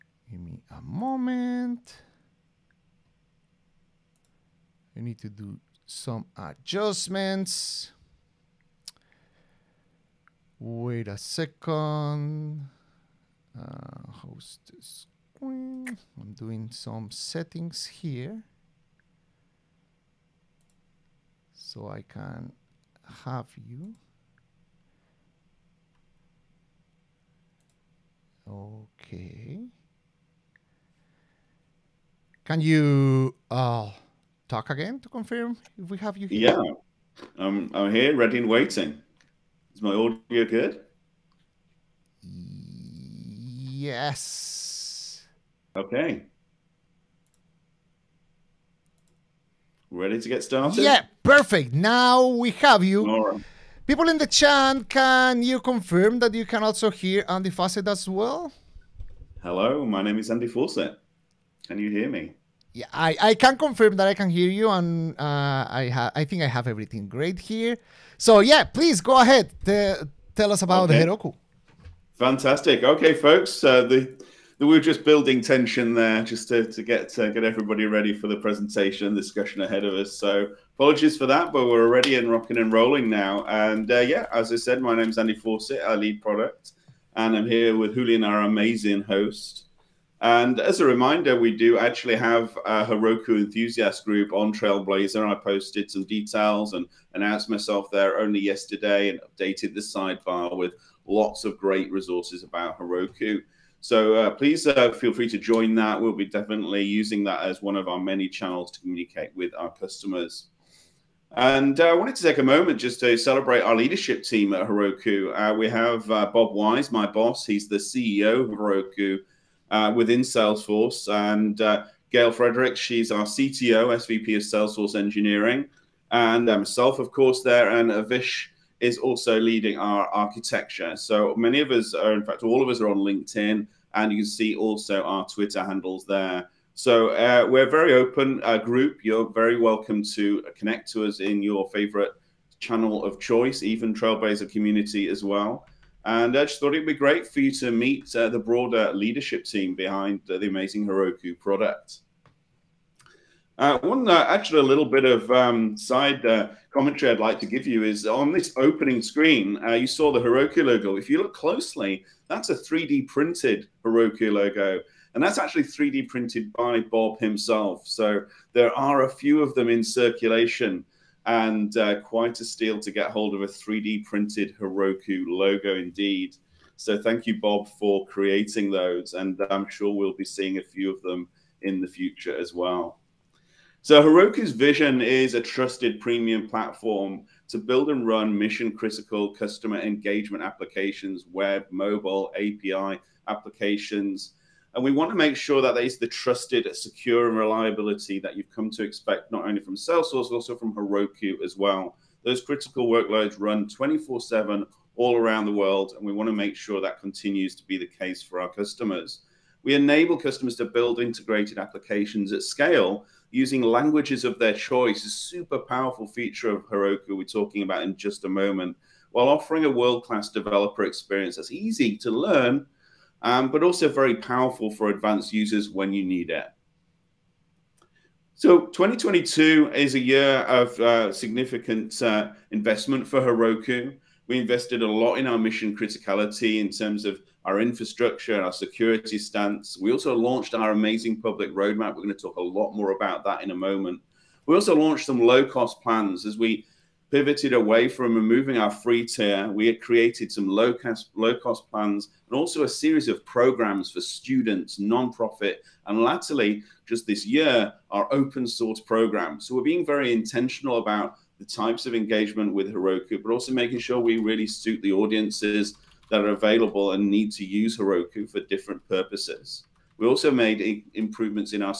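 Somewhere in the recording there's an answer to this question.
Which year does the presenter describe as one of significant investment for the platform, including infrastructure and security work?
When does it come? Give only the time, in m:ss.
3:48.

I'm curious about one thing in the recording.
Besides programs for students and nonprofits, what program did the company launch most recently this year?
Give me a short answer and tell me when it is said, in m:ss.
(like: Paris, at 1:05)
Open source program, at 4:18.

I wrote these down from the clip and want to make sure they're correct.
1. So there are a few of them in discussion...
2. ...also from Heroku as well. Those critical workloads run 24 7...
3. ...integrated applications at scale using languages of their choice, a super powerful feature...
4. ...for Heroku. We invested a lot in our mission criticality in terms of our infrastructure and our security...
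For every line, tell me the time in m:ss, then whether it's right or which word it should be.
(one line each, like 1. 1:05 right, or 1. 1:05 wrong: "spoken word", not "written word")
1. 2:47 wrong: "circulation", not "discussion"
2. 3:20 right
3. 3:30 right
4. 3:53 right.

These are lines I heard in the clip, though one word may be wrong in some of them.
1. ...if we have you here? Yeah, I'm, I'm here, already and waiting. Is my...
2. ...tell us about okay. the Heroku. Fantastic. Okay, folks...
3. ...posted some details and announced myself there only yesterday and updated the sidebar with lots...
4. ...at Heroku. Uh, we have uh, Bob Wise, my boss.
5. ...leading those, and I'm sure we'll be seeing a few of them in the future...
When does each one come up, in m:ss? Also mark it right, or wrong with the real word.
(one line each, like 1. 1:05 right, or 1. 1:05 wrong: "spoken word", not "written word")
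1. 0:35 wrong: "ready", not "already"
2. 1:10 right
3. 1:35 right
4. 1:54 right
5. 2:58 wrong: "creating", not "leading".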